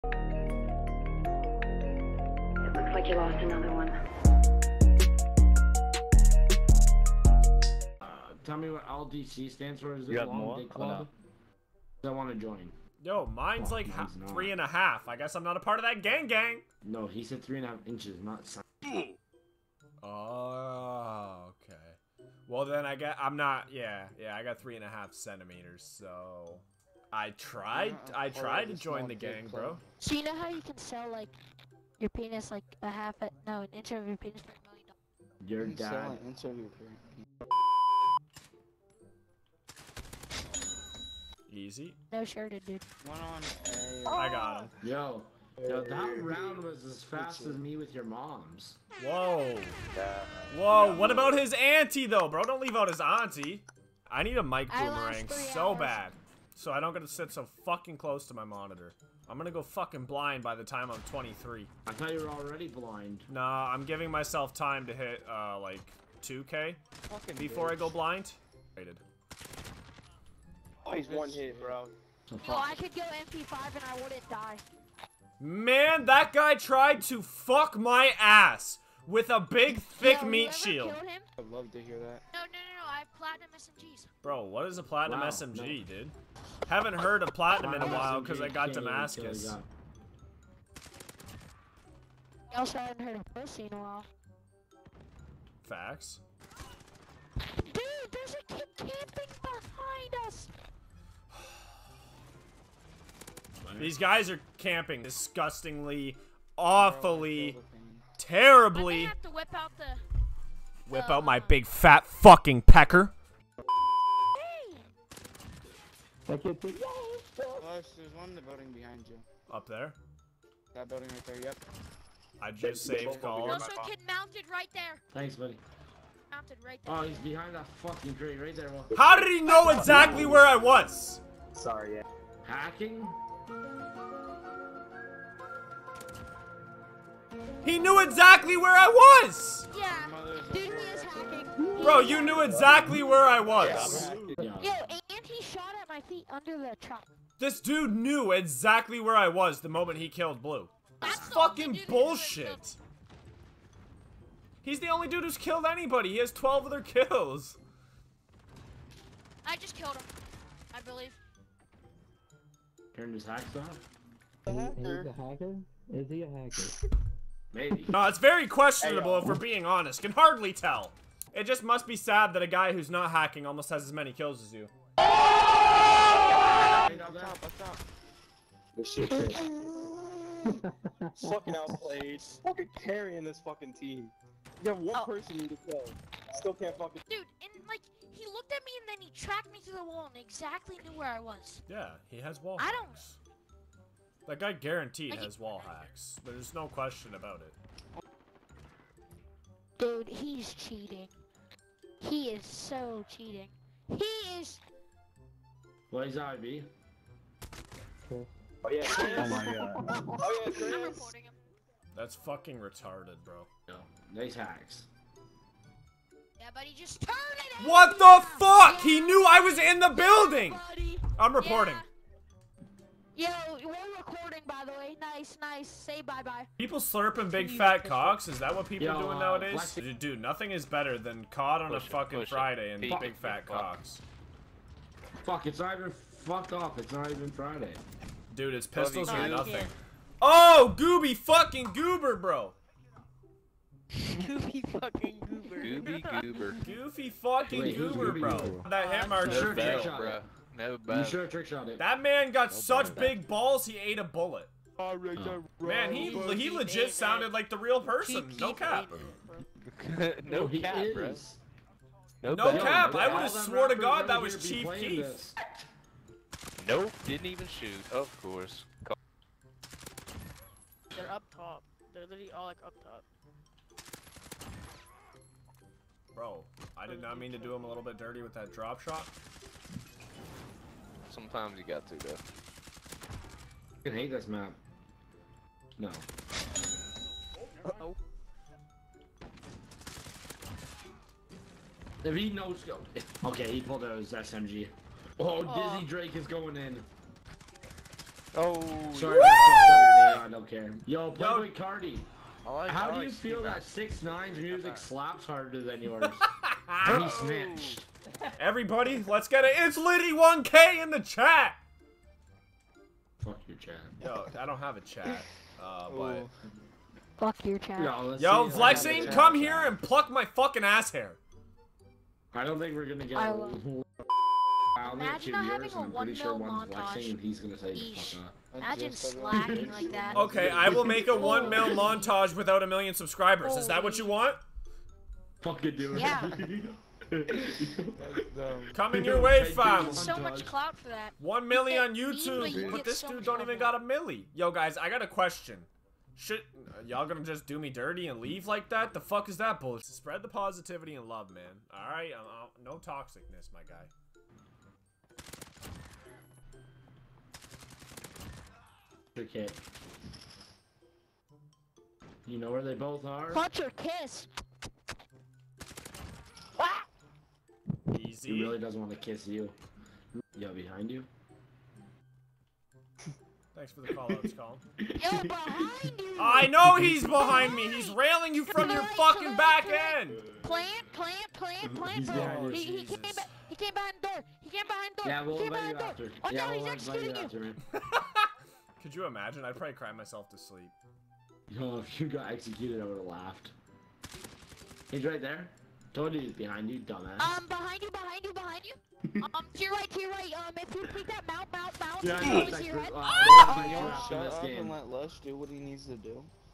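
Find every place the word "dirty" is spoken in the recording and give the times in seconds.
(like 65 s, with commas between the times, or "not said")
277 s, 347 s.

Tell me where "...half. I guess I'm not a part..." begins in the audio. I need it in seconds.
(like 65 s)
14 s.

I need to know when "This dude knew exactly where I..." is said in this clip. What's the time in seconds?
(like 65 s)
147 s.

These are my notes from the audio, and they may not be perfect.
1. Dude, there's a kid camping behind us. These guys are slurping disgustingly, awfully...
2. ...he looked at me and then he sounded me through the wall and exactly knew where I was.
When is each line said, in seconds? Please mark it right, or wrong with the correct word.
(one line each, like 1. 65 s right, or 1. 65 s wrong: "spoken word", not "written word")
1. 97 s wrong: "camping", not "slurping"
2. 188 s wrong: "tracked", not "sounded".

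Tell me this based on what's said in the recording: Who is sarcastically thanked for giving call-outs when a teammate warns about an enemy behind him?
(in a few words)
Colin.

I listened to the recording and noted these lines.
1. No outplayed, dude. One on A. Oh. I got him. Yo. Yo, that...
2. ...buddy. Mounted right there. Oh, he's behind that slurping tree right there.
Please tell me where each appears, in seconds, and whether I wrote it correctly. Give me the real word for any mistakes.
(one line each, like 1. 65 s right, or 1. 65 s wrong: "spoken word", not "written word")
1. 42 s wrong: "shirted", not "outplayed"
2. 125 s wrong: "fucking", not "slurping".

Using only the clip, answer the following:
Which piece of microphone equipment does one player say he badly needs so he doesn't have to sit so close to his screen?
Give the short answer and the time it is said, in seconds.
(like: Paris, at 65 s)
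mic boomerang, at 54 s.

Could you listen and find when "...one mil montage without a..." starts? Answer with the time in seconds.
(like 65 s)
331 s.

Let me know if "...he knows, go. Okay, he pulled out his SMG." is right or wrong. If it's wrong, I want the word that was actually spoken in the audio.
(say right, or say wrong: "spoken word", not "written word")
right.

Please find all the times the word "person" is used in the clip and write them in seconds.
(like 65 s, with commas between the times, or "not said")
185 s, 257 s.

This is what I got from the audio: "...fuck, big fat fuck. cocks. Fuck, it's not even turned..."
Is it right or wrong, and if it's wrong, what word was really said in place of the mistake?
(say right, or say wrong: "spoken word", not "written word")
wrong: "fucked", not "turned".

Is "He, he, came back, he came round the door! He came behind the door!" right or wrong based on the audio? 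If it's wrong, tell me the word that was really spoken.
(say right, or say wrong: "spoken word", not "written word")
wrong: "behind", not "round".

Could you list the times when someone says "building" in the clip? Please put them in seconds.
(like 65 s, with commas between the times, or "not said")
120 s, 219 s.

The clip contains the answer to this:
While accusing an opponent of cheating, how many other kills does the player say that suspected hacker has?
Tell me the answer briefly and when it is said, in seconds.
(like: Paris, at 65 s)
12, at 156 s.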